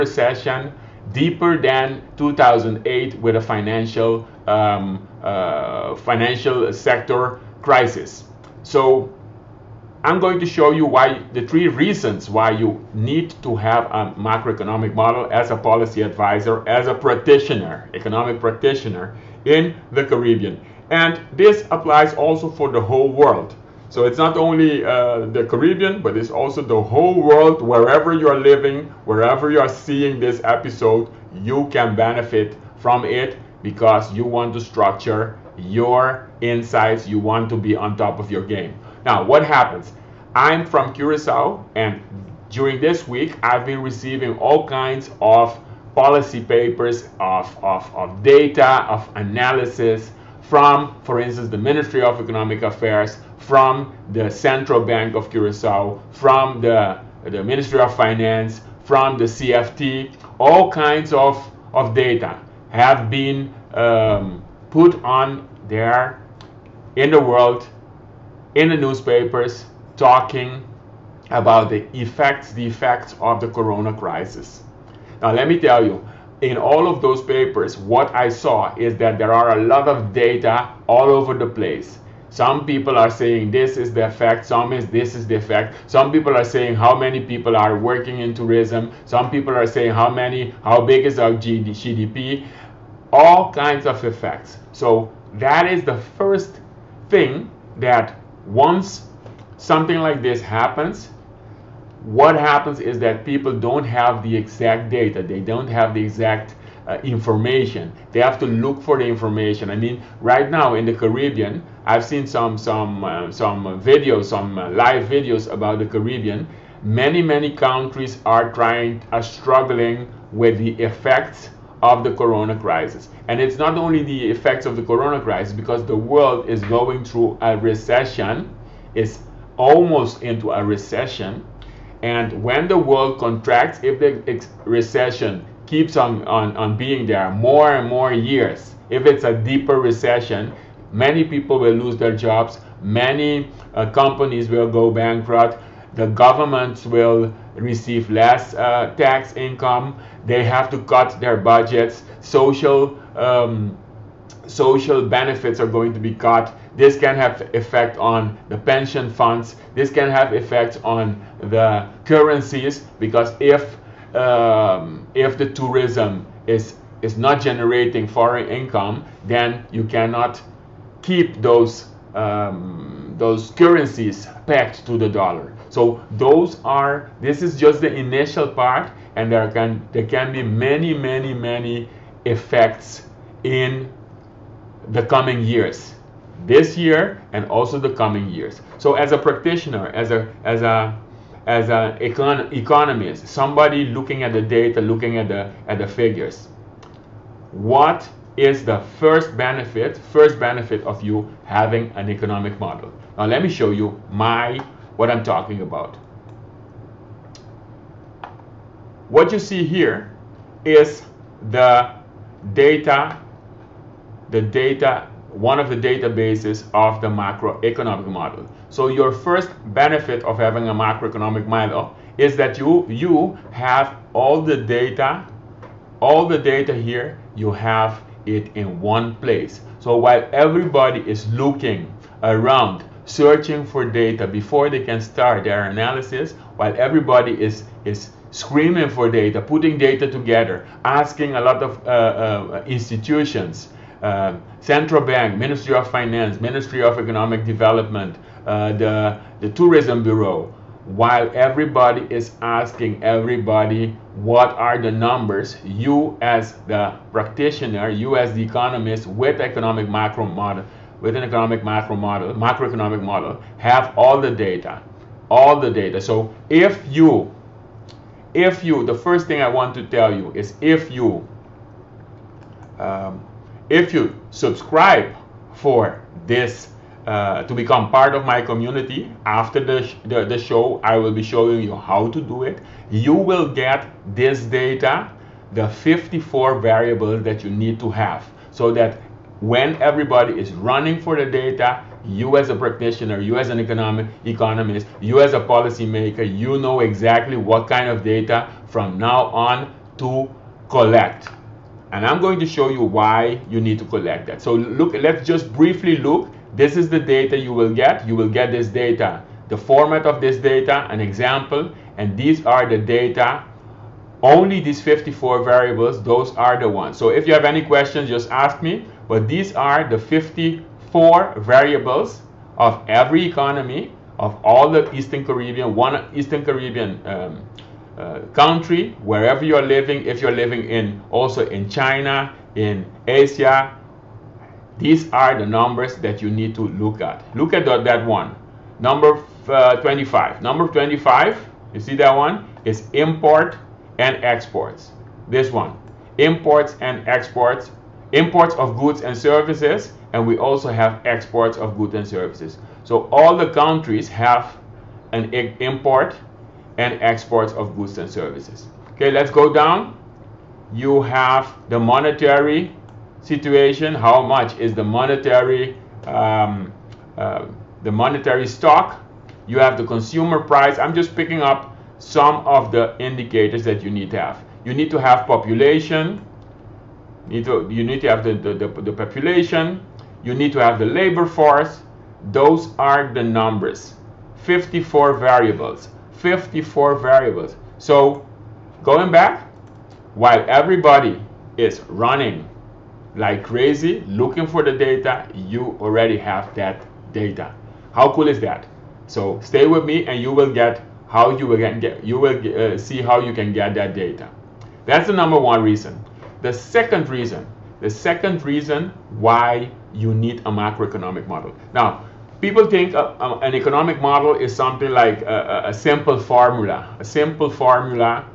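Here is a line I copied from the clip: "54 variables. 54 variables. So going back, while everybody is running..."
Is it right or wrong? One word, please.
right.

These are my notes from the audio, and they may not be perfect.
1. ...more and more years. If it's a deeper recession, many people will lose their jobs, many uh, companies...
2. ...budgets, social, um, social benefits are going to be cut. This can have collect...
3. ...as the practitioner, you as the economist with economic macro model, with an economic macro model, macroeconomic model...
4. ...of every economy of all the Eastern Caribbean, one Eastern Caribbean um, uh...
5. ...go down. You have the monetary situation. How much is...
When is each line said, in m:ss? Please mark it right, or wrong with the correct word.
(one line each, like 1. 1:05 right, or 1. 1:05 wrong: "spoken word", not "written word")
1. 2:17 right
2. 2:31 wrong: "effect", not "collect"
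3. 4:16 right
4. 5:22 right
5. 5:59 right.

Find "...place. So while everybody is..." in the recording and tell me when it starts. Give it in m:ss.
3:49.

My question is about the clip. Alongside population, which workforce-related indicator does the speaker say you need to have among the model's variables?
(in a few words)
labor force.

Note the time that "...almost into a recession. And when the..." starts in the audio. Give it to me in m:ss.
2:09.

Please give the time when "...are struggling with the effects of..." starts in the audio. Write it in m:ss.
1:59.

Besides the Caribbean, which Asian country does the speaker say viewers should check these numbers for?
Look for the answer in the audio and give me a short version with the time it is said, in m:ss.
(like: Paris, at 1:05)
China, at 5:31.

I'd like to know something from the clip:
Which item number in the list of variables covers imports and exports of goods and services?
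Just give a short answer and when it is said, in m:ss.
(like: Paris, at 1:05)
25, at 5:40.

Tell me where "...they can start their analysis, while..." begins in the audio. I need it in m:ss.
3:54.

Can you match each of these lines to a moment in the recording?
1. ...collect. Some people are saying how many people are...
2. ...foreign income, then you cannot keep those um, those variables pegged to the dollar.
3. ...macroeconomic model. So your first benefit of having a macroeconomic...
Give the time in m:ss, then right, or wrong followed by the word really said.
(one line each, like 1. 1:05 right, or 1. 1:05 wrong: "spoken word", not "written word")
1. 1:25 wrong: "effect", not "collect"
2. 2:48 wrong: "currencies", not "variables"
3. 3:37 right.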